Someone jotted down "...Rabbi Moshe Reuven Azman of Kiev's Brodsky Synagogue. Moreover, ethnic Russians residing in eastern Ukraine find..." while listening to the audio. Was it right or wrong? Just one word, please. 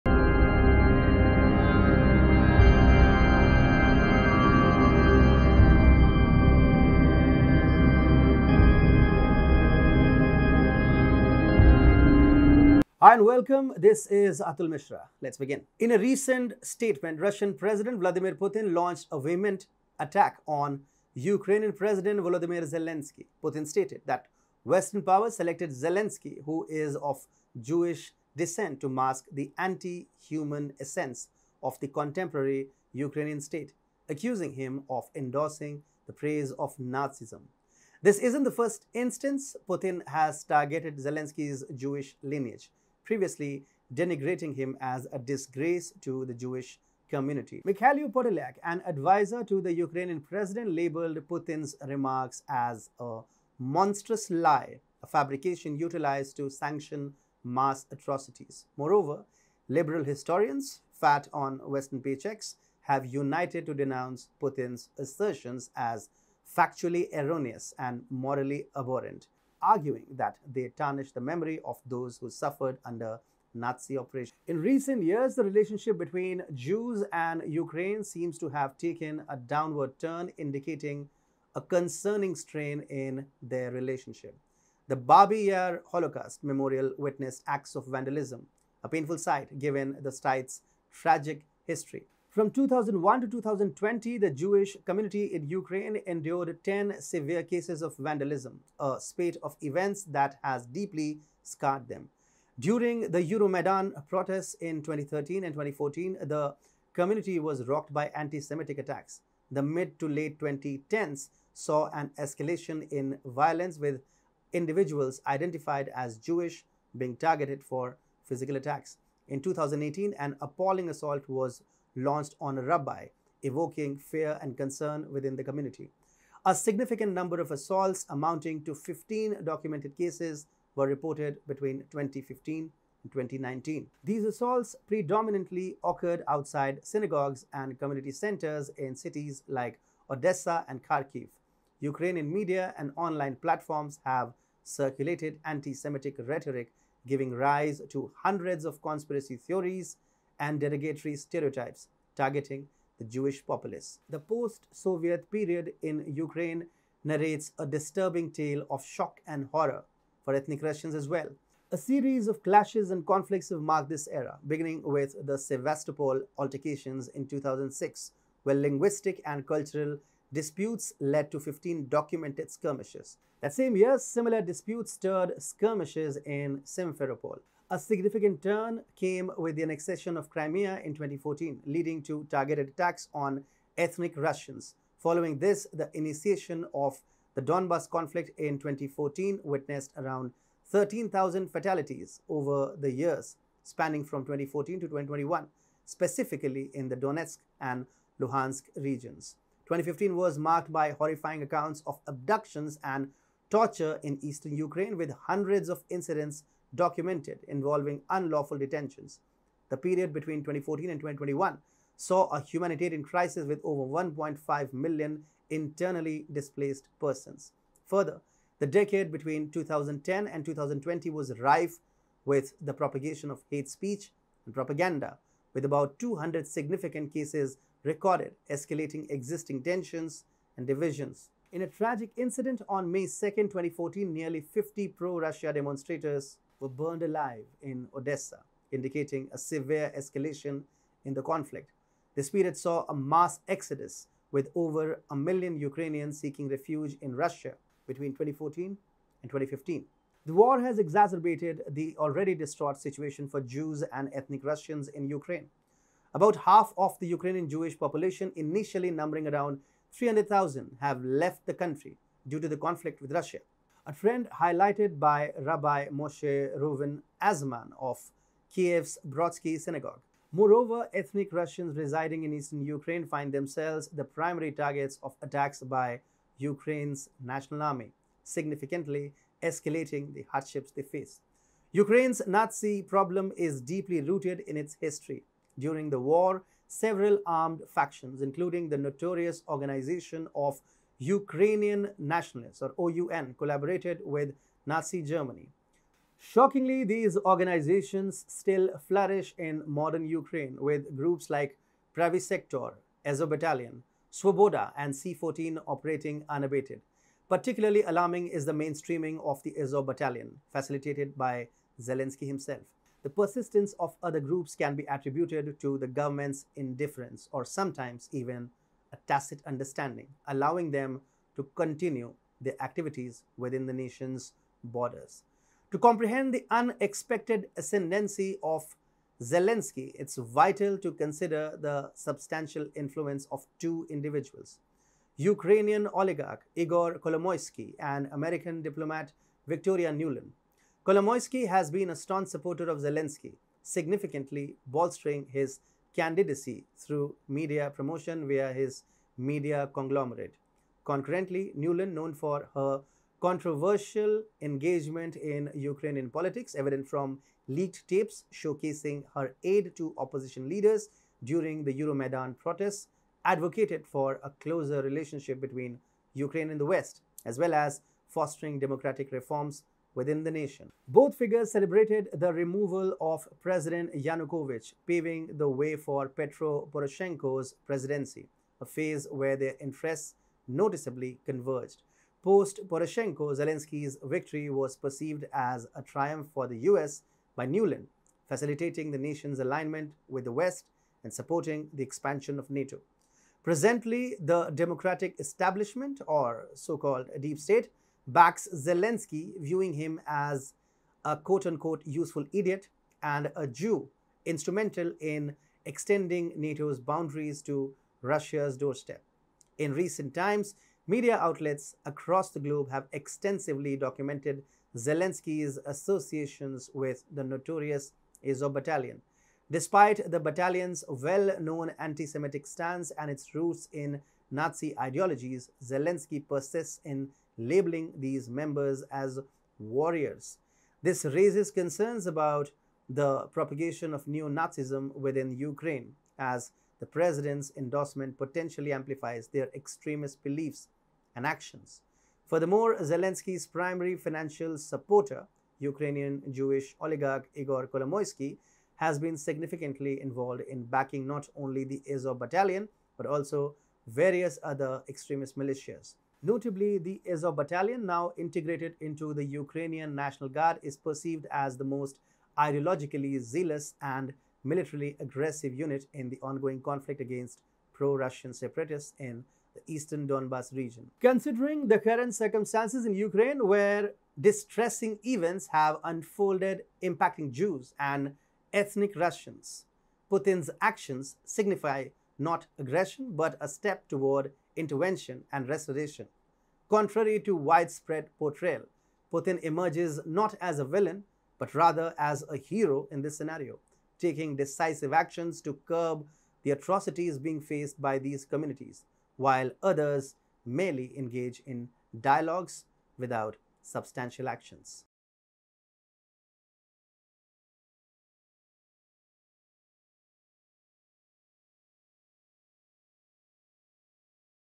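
right.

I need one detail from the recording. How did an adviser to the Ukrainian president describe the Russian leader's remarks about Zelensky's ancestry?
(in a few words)
monstrous lie.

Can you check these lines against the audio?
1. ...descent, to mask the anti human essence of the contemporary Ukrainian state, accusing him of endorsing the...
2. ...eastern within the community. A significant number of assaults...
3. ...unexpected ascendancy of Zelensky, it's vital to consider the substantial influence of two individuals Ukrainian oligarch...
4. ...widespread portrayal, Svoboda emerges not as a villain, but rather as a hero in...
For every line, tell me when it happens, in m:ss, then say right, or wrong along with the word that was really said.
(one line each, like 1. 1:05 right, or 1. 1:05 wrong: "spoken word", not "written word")
1. 0:28 right
2. 2:04 wrong: "concern", not "eastern"
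3. 5:26 right
4. 8:07 wrong: "Putin", not "Svoboda".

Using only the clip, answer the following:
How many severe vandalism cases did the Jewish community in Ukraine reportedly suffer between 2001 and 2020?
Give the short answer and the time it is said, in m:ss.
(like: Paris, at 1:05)
10, at 1:36.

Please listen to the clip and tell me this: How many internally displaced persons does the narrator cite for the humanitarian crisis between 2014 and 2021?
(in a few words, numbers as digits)
over 1.5 million.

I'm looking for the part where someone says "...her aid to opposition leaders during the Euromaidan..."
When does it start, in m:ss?
5:59.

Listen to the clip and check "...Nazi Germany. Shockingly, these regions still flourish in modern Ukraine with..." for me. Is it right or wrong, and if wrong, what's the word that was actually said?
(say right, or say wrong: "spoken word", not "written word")
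wrong: "organizations", not "regions".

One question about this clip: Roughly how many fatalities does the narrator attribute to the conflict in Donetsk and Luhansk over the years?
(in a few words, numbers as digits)
13,000.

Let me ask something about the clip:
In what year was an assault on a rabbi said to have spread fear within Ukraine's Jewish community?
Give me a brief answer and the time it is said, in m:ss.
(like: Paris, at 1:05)
2018, at 1:59.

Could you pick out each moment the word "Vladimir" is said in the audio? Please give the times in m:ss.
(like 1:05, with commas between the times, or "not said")
0:17.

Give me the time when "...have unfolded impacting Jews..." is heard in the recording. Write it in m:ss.
7:55.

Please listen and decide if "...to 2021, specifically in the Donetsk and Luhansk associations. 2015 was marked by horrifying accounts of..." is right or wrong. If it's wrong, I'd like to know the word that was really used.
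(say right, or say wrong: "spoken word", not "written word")
wrong: "regions", not "associations".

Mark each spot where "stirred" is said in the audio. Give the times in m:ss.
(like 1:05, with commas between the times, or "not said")
2:54.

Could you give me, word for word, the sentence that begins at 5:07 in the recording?
Particularly alarming is the mainstreaming of the Azov Battalion, facilitated by Zelensky himself.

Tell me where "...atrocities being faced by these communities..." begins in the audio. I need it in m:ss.
8:16.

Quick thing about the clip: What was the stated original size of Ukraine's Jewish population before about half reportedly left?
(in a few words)
300,000.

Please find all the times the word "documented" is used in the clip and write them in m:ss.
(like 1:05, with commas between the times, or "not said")
2:09, 2:51, 3:26, 6:53.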